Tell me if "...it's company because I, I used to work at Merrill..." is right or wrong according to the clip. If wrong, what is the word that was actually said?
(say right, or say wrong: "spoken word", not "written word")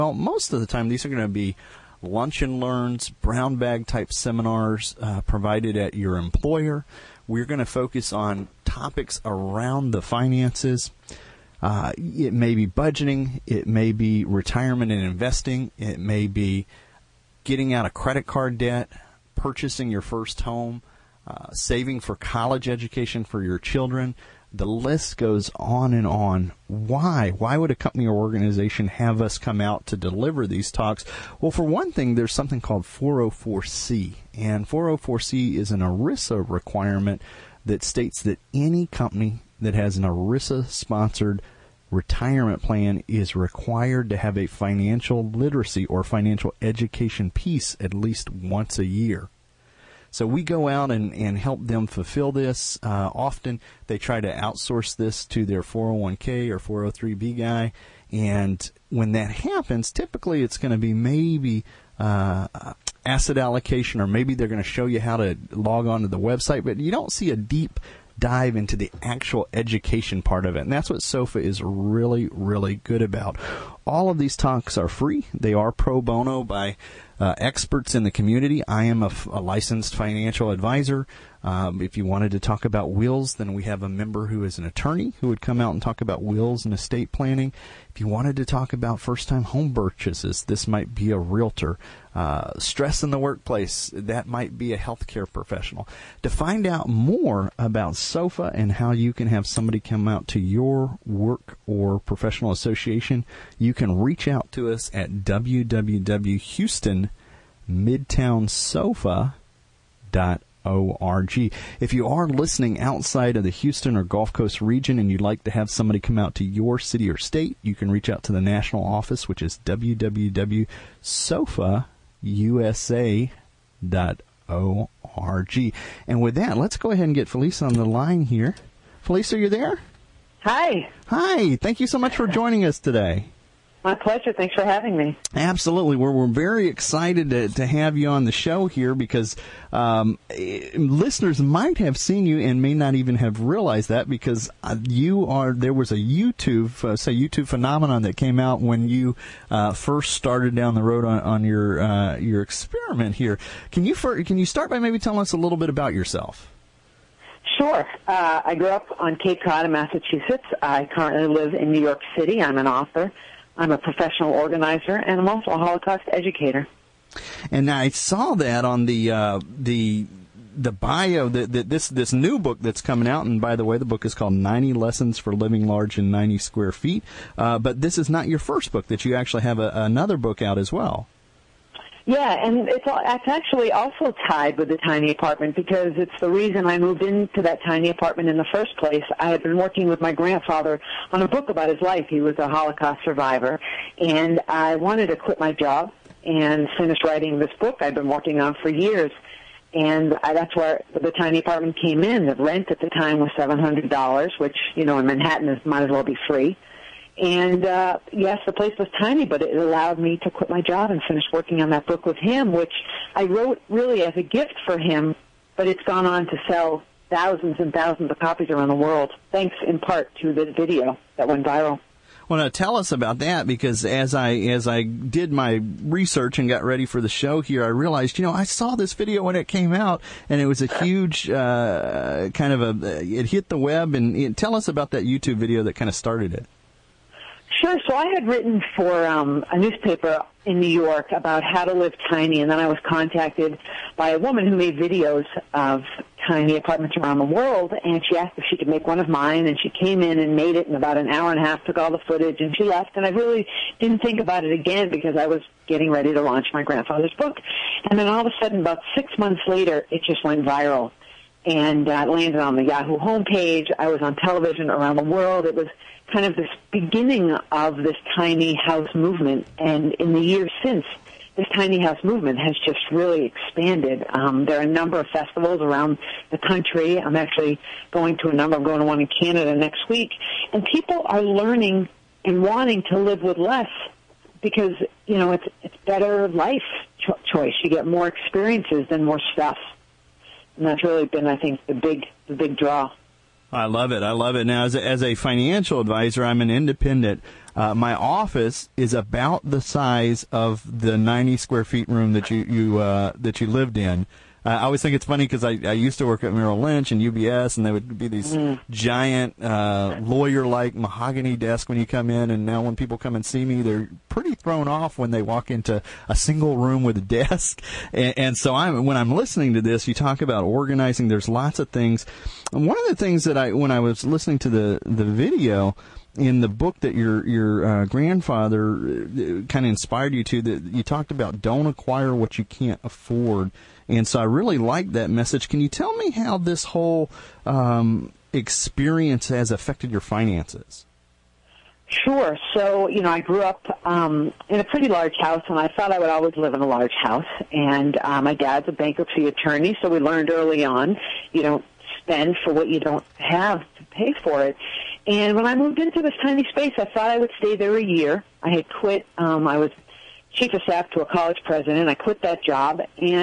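wrong: "funny", not "company".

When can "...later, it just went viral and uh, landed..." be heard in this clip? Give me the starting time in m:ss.
4:19.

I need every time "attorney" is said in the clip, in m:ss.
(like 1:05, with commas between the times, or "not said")
1:24, 5:49.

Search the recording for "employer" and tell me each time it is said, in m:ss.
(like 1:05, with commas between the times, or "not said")
0:06.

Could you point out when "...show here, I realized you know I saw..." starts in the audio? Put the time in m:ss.
3:47.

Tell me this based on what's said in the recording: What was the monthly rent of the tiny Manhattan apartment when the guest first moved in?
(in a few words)
$700.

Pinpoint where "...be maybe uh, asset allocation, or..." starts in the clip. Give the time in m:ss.
1:00.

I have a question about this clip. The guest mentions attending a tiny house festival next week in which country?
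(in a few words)
Canada.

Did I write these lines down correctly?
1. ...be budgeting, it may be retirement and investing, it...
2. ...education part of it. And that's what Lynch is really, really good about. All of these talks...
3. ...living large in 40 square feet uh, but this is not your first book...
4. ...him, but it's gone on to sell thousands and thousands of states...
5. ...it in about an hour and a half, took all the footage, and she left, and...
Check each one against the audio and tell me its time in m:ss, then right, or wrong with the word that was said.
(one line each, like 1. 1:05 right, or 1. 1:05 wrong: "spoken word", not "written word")
1. 0:12 right
2. 1:09 wrong: "SOFA", not "Lynch"
3. 2:55 wrong: "90", not "40"
4. 3:34 wrong: "copies", not "states"
5. 4:10 right.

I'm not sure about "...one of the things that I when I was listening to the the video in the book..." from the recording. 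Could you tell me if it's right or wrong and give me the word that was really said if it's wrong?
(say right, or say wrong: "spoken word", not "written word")
right.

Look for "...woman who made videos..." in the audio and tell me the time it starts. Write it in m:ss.
4:04.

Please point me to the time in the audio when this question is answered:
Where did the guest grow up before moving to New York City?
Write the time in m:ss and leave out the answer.
2:39.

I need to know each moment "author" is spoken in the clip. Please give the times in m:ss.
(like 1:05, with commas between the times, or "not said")
2:42.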